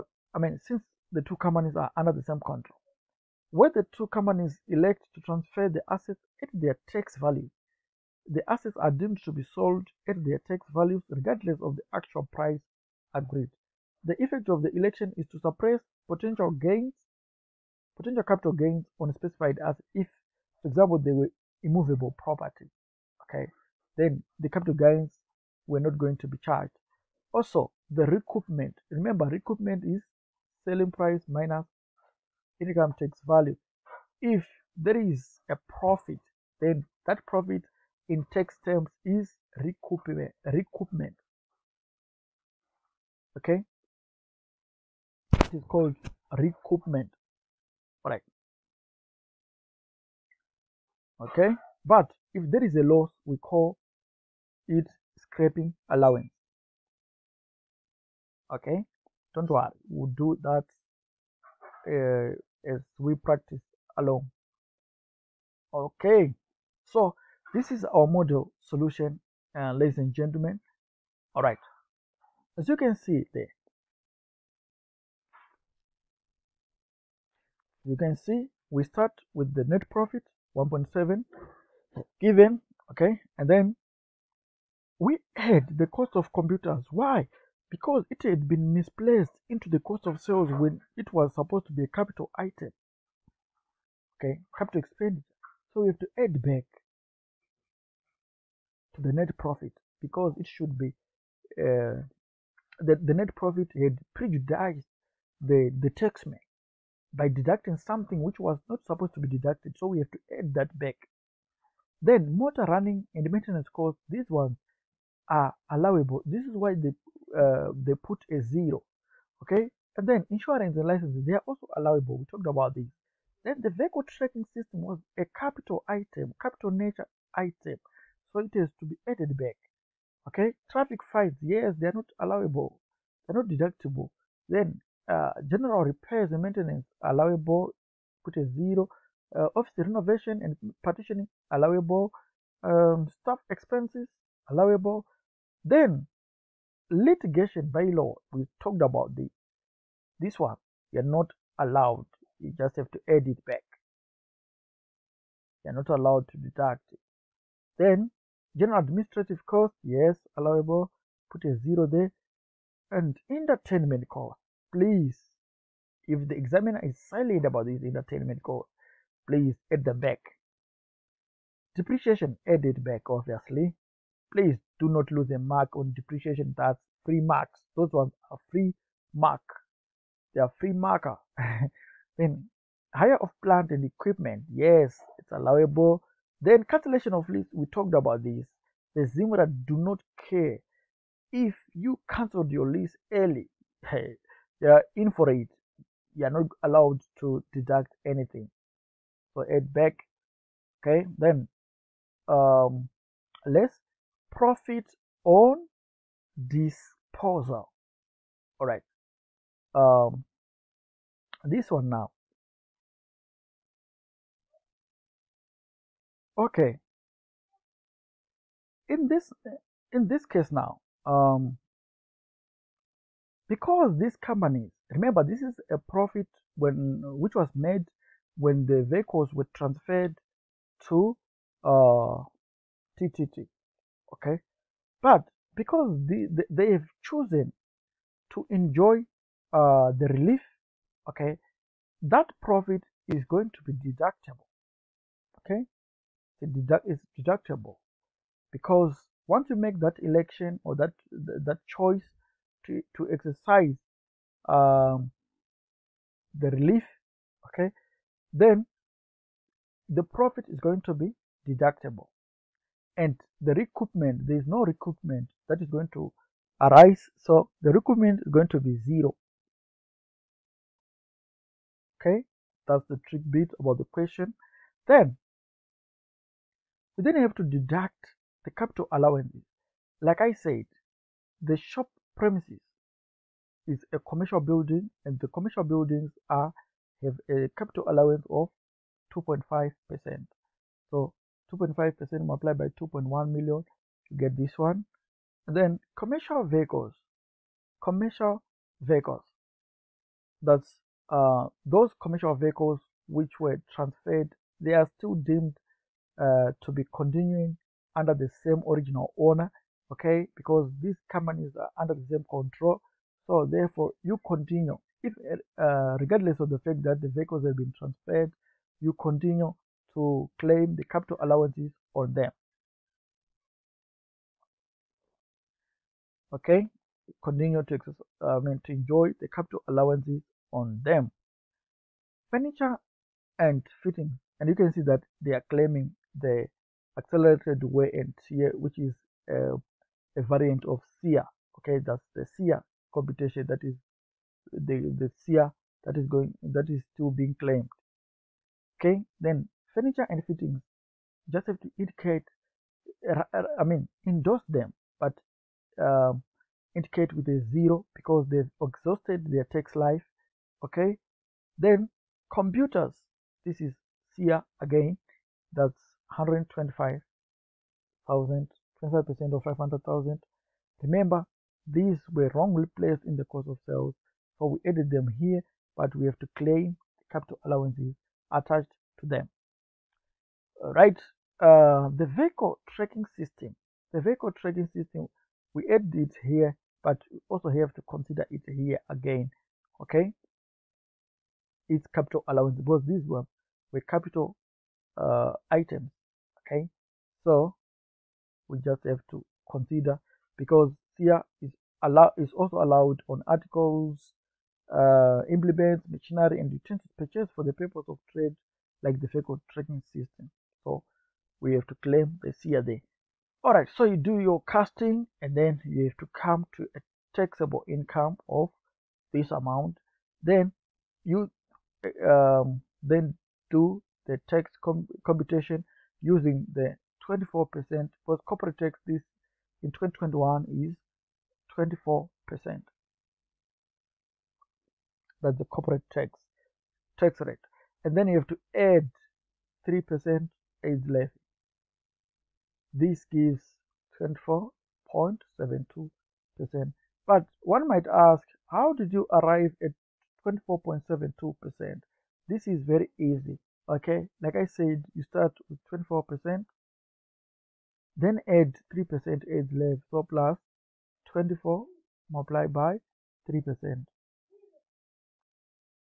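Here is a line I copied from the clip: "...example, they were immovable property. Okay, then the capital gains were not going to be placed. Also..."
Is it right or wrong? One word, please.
wrong.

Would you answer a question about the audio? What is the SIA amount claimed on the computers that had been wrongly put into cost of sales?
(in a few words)
125,000.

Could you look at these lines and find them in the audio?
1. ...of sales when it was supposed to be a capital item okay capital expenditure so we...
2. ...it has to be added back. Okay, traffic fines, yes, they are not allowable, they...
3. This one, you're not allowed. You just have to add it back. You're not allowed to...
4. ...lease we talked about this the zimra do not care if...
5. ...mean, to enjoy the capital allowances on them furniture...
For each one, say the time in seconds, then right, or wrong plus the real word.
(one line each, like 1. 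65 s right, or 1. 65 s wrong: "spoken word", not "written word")
1. 90 s right
2. 128 s right
3. 150 s right
4. 187 s right
5. 328 s right.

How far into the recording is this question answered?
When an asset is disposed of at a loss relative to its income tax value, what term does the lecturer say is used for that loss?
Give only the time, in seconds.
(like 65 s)
55 s.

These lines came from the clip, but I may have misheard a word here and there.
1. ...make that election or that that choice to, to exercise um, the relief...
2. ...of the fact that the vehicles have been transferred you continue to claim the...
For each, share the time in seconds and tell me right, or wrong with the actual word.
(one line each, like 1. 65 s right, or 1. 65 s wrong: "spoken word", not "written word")
1. 249 s right
2. 316 s right.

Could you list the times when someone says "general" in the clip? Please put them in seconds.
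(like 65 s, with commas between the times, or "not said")
135 s, 158 s.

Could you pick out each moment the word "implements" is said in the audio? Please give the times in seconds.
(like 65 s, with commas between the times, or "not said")
405 s.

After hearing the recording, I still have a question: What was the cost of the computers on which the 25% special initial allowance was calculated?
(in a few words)
500,000.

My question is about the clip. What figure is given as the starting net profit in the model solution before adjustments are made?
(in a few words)
1.7.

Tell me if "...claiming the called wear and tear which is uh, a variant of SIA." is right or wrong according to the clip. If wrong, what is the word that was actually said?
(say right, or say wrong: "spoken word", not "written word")
wrong: "accelerated", not "called".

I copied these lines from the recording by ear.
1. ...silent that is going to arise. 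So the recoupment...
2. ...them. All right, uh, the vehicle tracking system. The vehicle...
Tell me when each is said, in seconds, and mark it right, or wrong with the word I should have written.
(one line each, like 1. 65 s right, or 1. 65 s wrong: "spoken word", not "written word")
1. 264 s wrong: "recoupment", not "silent"
2. 379 s right.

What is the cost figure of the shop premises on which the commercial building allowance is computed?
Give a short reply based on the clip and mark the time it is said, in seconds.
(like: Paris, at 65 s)
2.1 million, at 292 s.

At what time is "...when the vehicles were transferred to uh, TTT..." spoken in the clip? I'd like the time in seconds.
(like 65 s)
228 s.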